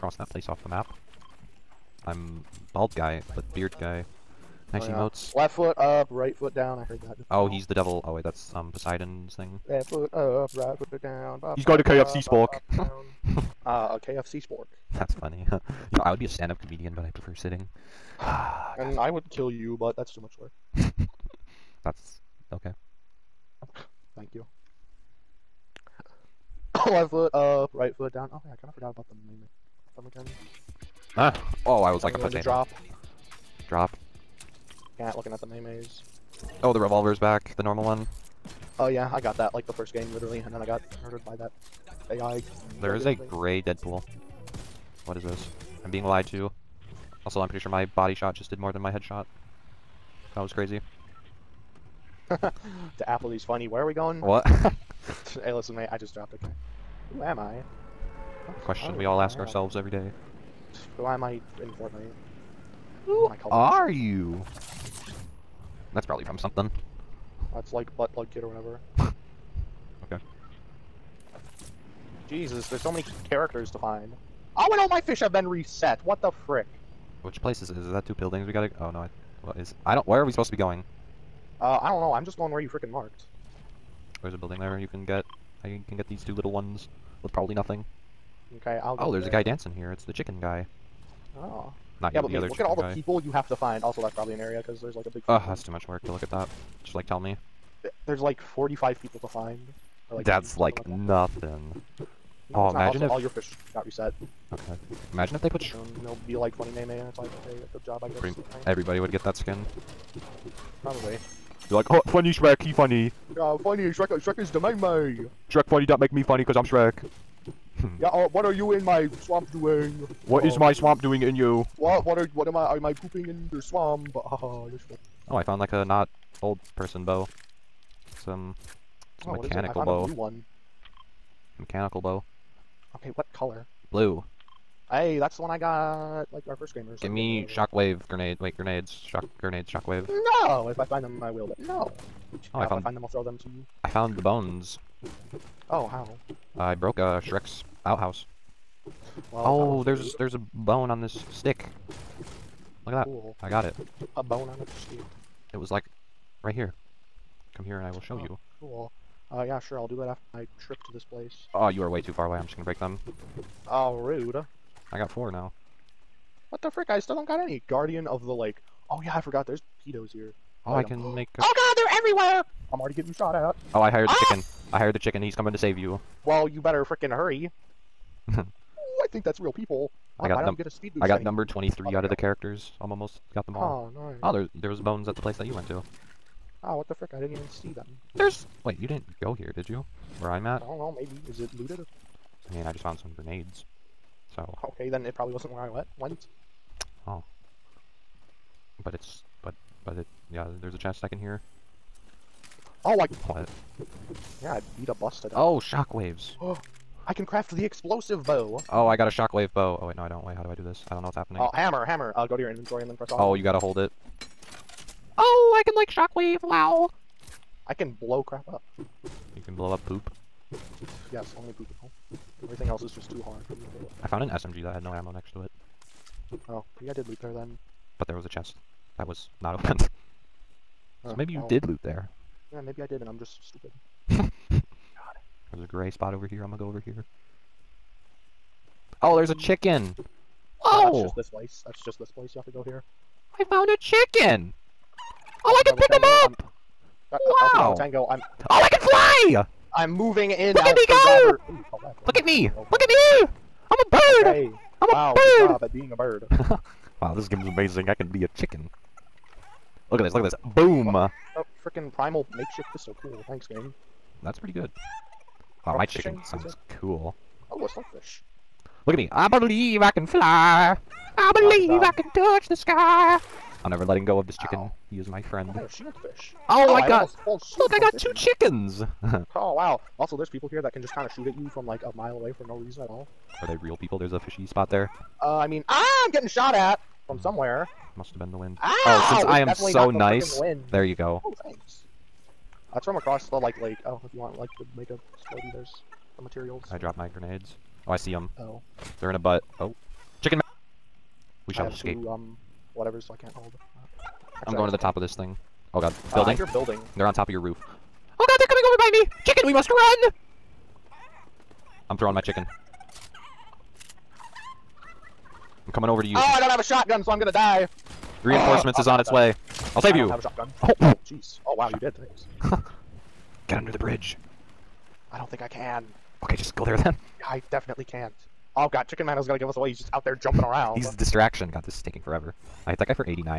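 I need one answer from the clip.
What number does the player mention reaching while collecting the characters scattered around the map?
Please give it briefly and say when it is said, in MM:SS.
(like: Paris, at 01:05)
23, at 03:01.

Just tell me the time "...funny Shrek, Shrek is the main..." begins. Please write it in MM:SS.
01:53.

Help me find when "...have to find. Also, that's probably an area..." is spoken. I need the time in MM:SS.
01:33.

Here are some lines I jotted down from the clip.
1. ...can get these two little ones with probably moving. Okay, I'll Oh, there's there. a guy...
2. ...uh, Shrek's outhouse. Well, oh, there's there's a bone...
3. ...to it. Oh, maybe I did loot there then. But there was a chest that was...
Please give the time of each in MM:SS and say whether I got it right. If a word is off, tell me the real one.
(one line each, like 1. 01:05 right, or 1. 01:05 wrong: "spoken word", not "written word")
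1. 01:25 wrong: "nothing", not "moving"
2. 02:26 right
3. 03:45 right.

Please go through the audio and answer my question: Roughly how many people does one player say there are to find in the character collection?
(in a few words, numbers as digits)
45.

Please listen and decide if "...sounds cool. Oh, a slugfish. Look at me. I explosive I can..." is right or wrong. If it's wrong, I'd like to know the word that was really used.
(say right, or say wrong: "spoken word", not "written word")
wrong: "believe", not "explosive".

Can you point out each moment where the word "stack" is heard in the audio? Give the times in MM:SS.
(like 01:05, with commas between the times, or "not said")
not said.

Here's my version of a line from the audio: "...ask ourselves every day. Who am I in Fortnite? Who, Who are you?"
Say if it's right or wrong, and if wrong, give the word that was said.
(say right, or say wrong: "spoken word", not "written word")
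right.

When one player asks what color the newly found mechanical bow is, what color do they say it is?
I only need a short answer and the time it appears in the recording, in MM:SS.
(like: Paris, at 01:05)
Blue, at 02:13.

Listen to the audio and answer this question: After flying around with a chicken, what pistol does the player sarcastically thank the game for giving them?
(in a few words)
Primal makeshift pistol.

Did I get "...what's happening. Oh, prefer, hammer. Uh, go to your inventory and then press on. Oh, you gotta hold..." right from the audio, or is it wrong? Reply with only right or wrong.
wrong.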